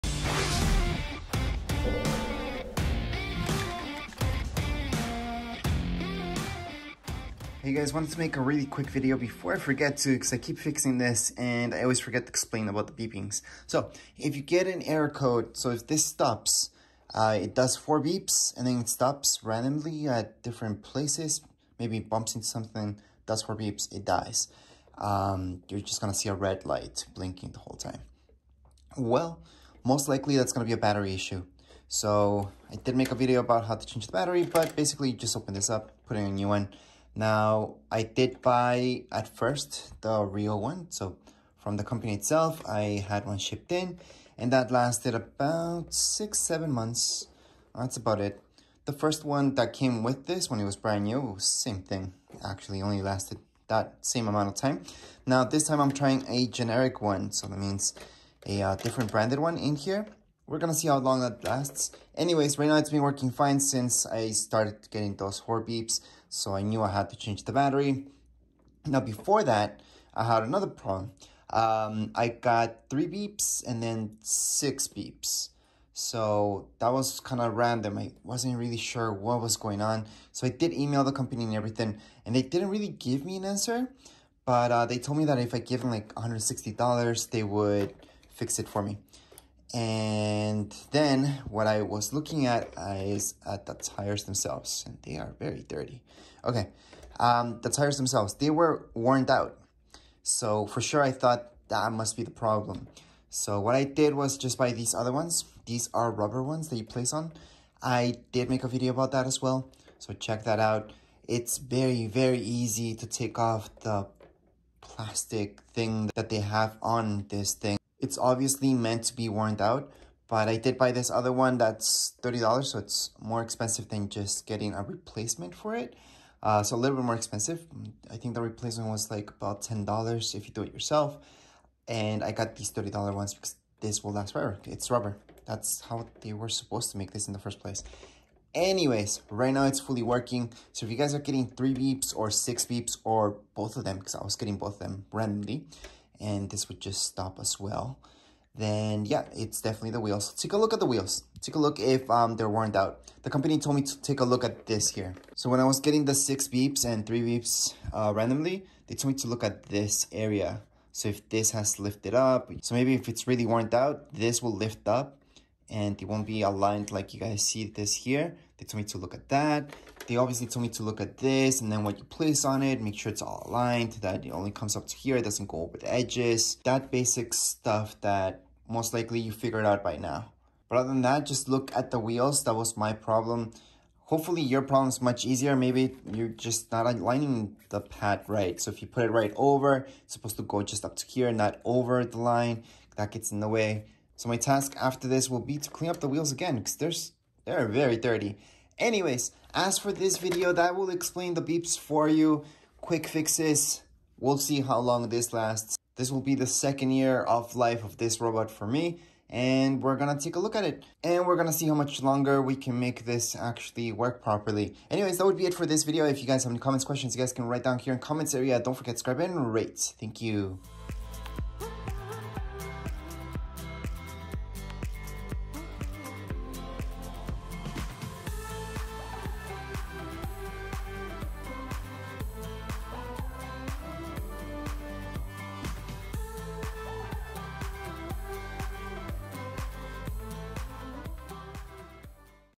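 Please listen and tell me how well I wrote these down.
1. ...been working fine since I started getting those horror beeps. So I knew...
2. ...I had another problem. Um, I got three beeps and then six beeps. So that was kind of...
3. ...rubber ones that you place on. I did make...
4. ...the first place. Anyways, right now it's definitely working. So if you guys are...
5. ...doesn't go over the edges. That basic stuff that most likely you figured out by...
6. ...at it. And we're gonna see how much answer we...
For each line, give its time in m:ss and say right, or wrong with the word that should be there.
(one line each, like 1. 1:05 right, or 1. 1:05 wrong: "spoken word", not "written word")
1. 1:02 right
2. 1:10 right
3. 1:46 right
4. 2:17 wrong: "fully", not "definitely"
5. 2:55 right
6. 3:30 wrong: "longer", not "answer".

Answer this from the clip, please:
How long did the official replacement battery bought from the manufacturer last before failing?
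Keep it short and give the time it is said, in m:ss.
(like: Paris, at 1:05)
6 or 7 months, at 0:45.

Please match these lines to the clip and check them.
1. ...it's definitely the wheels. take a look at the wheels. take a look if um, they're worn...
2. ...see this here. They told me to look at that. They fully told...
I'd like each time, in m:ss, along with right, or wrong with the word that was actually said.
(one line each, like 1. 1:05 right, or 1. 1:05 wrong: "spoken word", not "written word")
1. 2:29 right
2. 2:47 wrong: "obviously", not "fully".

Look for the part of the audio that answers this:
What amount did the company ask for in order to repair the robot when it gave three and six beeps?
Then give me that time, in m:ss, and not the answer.
1:26.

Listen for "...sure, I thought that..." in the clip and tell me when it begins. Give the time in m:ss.
1:40.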